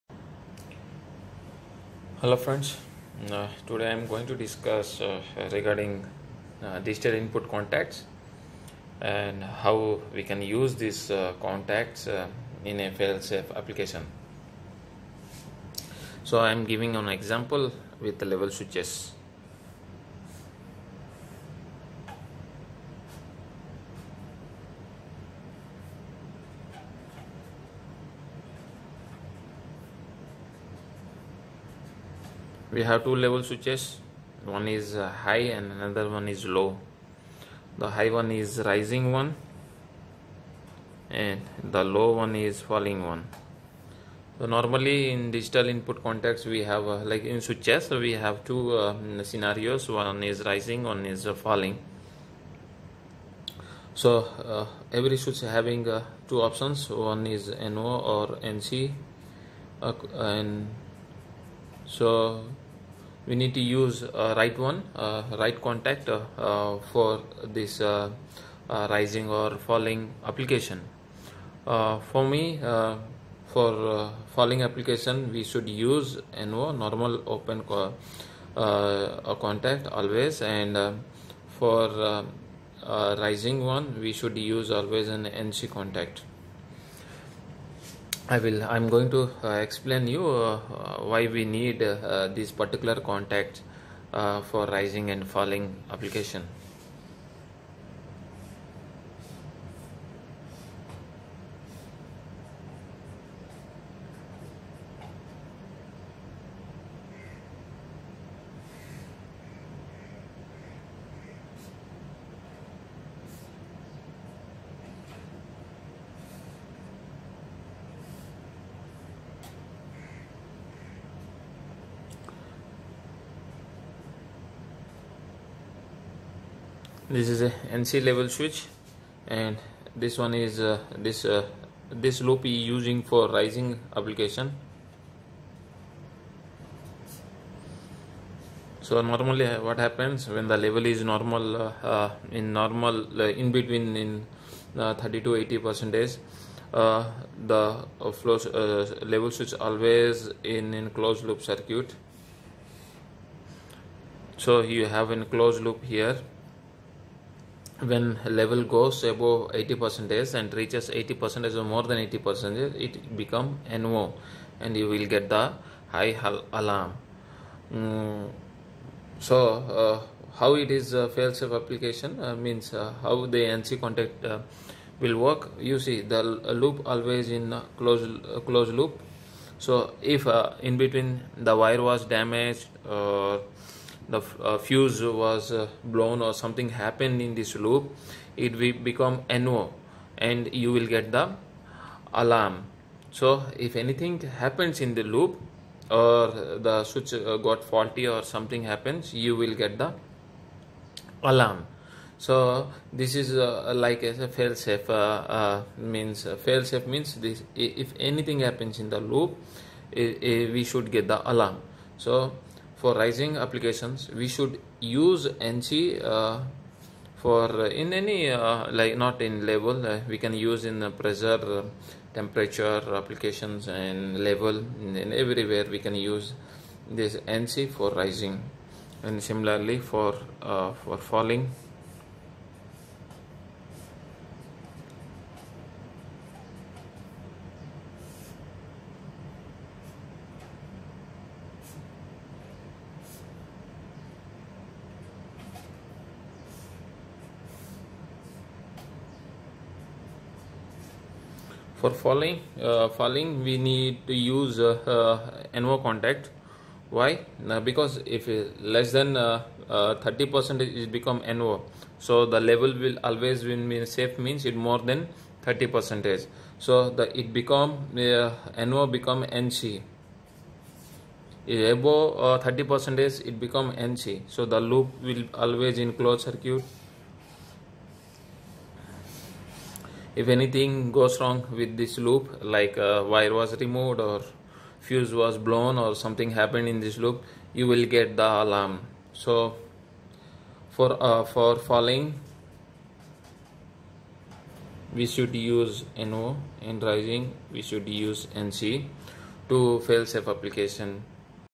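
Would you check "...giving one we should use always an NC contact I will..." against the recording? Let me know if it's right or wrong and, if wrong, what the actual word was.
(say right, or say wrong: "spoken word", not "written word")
wrong: "rising", not "giving".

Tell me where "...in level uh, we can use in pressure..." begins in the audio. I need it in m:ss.
3:39.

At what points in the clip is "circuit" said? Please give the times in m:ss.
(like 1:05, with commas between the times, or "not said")
2:31, 4:36.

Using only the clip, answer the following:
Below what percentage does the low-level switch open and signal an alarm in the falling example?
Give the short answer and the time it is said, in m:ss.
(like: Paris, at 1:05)
30 percent, at 4:20.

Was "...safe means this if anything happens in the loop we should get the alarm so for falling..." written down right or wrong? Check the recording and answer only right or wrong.
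wrong.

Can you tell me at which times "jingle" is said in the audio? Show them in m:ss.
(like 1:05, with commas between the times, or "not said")
not said.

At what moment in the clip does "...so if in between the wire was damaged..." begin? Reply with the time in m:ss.
2:59.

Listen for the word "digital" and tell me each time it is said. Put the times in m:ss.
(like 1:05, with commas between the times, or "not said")
0:06, 0:45.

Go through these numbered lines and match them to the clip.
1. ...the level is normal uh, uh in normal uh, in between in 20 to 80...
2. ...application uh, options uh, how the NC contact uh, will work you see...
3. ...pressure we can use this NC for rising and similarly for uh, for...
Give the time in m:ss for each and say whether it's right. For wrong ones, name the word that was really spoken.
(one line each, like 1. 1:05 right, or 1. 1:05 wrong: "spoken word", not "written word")
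1. 2:20 wrong: "30", not "20"
2. 2:51 wrong: "means", not "options"
3. 3:45 wrong: "everywhere", not "pressure".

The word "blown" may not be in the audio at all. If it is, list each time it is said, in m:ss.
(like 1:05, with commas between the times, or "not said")
3:05, 4:45.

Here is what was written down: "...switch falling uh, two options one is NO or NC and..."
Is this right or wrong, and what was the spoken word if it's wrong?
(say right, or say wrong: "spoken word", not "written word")
wrong: "having", not "falling".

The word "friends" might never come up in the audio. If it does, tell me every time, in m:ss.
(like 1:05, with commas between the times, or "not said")
0:02.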